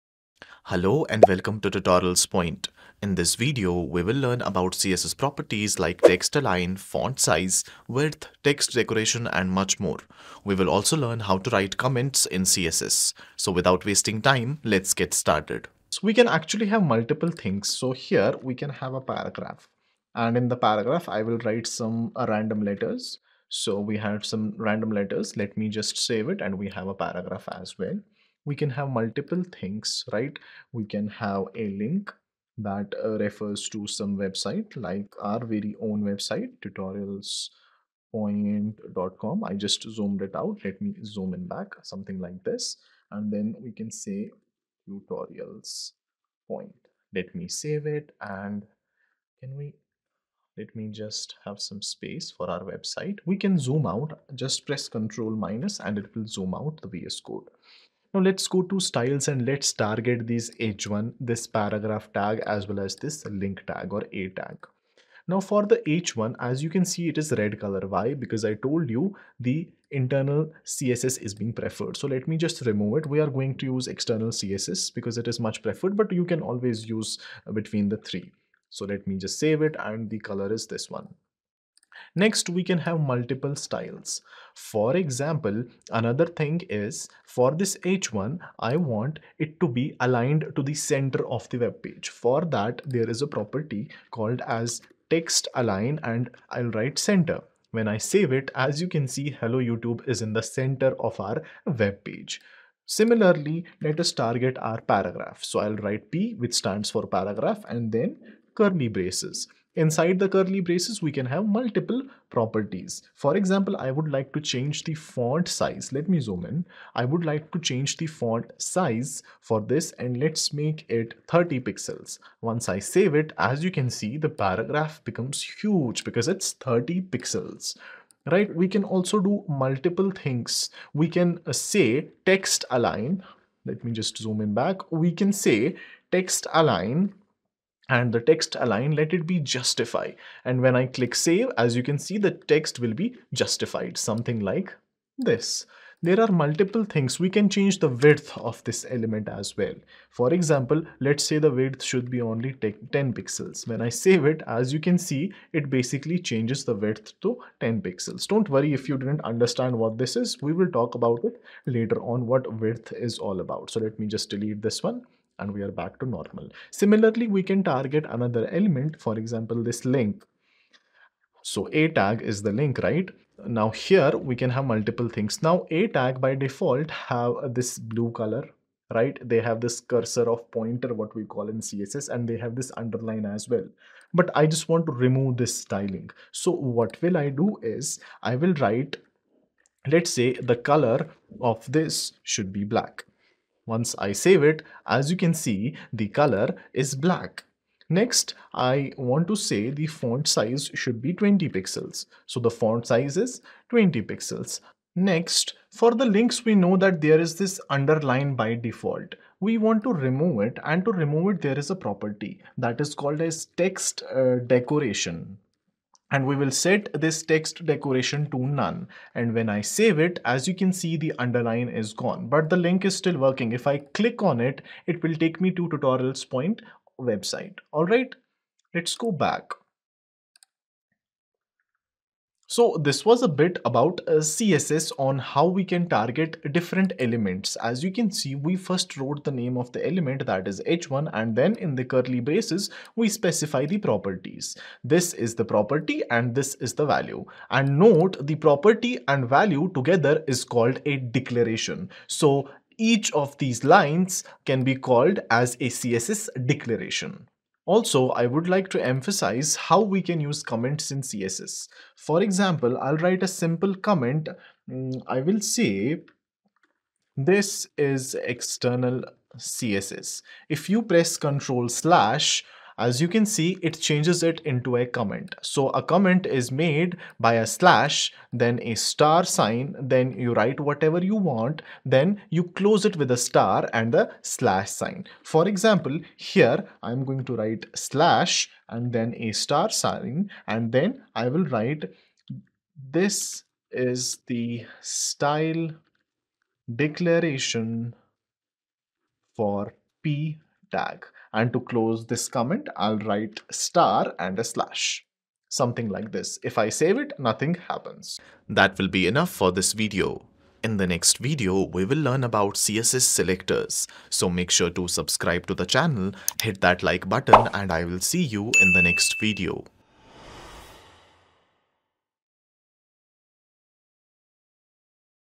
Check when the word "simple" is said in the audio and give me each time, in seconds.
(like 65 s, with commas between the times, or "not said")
263 s.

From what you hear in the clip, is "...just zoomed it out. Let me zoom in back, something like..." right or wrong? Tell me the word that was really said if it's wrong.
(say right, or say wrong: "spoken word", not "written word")
right.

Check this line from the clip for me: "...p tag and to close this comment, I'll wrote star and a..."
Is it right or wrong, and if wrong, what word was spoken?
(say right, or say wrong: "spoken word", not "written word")
wrong: "write", not "wrote".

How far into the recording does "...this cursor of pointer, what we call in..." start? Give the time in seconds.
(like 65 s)
179 s.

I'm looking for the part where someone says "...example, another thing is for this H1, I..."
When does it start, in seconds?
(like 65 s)
84 s.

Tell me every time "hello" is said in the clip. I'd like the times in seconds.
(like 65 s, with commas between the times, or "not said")
0 s, 99 s.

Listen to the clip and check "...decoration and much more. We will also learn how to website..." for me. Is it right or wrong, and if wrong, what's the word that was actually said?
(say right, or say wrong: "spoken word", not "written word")
wrong: "write", not "website".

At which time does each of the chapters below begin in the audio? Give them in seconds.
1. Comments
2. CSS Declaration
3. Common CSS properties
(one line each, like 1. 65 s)
1. 257 s
2. 237 s
3. 16 s.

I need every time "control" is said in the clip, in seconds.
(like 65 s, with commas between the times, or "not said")
54 s, 271 s.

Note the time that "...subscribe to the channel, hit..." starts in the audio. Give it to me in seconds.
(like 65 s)
314 s.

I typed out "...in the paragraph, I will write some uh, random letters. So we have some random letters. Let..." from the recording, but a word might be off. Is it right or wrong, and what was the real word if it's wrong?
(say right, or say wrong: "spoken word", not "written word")
right.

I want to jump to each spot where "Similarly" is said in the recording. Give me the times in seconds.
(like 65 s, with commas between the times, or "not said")
102 s, 166 s.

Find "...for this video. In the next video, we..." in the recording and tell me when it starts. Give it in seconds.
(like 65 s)
309 s.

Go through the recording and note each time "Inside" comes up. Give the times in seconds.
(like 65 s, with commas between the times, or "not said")
109 s.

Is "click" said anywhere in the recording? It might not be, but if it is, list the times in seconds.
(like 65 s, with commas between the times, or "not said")
140 s, 224 s.